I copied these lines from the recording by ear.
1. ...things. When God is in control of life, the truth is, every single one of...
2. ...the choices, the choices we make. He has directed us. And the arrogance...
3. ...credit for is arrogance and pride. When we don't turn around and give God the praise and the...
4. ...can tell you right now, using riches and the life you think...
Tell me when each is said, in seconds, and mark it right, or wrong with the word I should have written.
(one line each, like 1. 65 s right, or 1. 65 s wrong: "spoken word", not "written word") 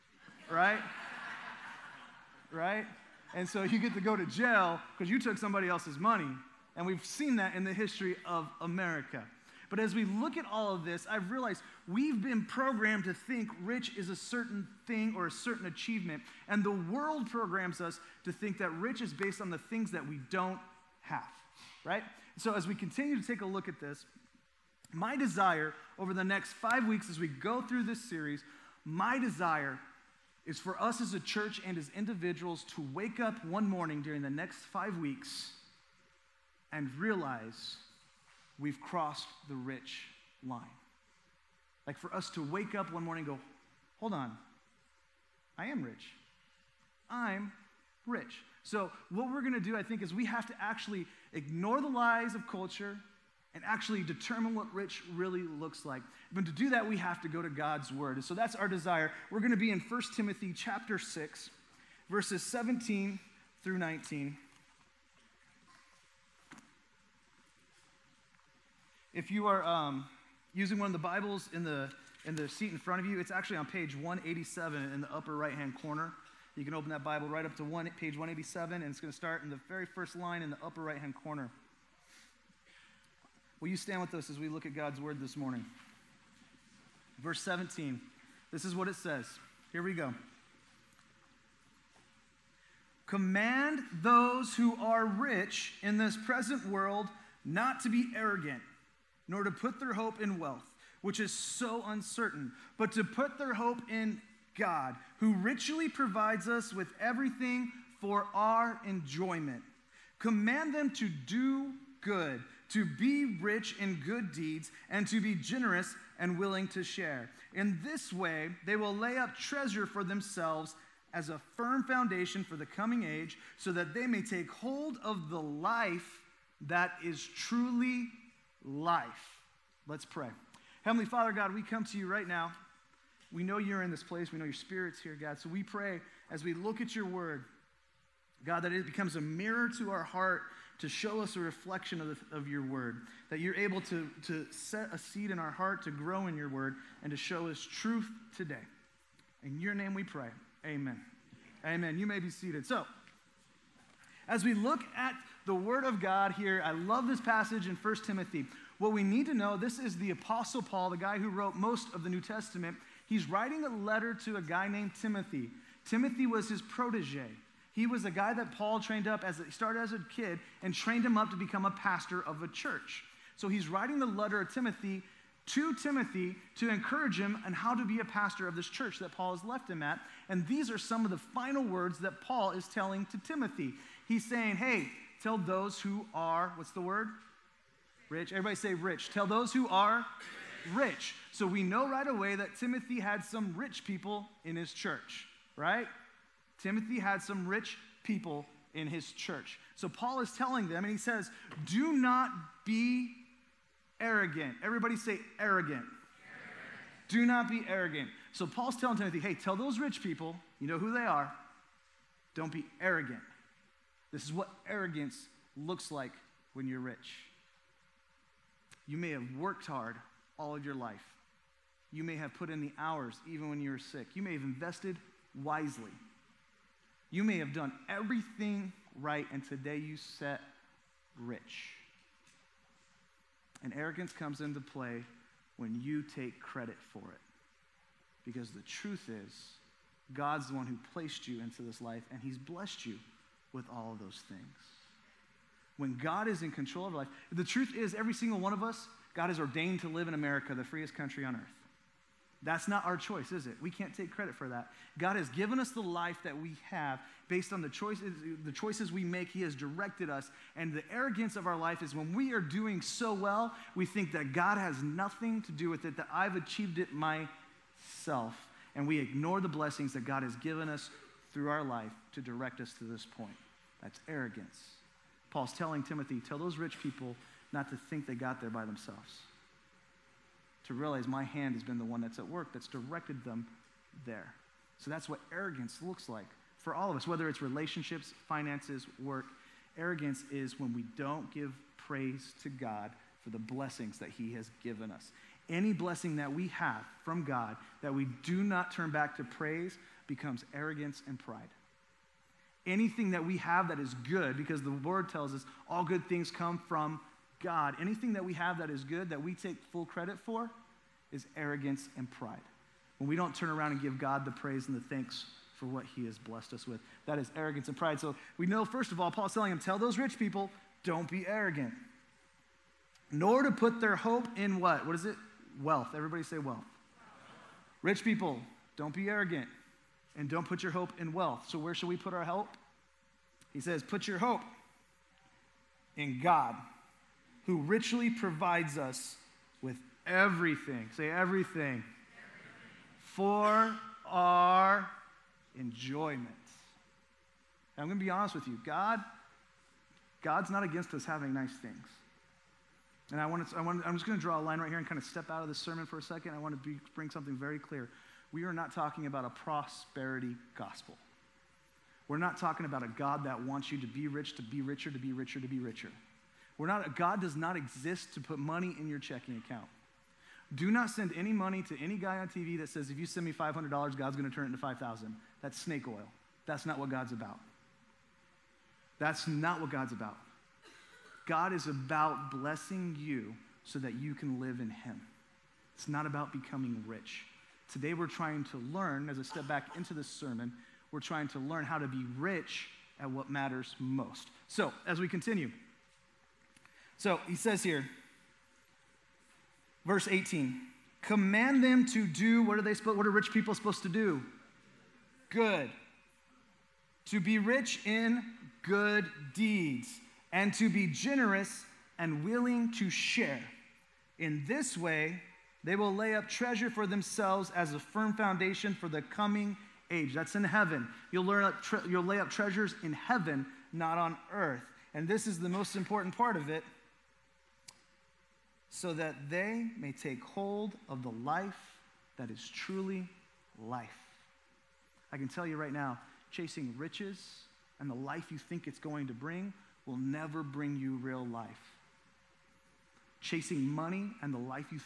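1. 244 s right
2. 257 s right
3. 309 s right
4. 435 s wrong: "chasing", not "using".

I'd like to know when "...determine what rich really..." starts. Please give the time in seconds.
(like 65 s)
54 s.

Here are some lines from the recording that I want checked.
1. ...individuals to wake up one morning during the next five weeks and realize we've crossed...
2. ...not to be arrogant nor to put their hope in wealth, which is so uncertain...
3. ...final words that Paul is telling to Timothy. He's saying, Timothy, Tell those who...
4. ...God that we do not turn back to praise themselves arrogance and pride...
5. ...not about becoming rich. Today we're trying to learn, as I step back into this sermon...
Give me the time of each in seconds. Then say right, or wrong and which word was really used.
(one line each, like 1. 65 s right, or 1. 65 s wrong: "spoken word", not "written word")
1. 31 s right
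2. 97 s right
3. 181 s wrong: "Hey", not "Timothy"
4. 297 s wrong: "becomes", not "themselves"
5. 385 s right.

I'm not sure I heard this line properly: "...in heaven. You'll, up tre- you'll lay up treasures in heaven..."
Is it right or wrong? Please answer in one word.
right.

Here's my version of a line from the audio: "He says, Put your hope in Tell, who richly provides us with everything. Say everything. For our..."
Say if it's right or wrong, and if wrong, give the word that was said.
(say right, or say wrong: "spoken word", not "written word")
wrong: "God", not "Tell".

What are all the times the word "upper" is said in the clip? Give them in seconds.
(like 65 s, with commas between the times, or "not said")
75 s, 80 s.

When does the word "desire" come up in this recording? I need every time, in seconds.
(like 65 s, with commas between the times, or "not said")
25 s, 29 s, 58 s.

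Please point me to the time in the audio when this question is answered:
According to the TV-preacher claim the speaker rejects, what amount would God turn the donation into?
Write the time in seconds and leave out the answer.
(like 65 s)
374 s.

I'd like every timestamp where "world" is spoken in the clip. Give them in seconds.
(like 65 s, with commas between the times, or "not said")
16 s, 96 s.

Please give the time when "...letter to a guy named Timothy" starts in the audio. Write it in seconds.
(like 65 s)
163 s.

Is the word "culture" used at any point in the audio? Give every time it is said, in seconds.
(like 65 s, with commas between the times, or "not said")
52 s.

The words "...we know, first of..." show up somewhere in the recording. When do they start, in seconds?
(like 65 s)
318 s.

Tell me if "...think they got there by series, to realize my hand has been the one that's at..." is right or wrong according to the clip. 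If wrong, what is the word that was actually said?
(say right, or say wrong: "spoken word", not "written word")
wrong: "themselves", not "series".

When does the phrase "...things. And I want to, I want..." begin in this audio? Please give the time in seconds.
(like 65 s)
351 s.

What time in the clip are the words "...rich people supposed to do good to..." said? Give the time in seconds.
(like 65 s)
403 s.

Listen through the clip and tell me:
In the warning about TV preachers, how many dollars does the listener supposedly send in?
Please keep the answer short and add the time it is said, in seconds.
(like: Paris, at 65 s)
$500, at 373 s.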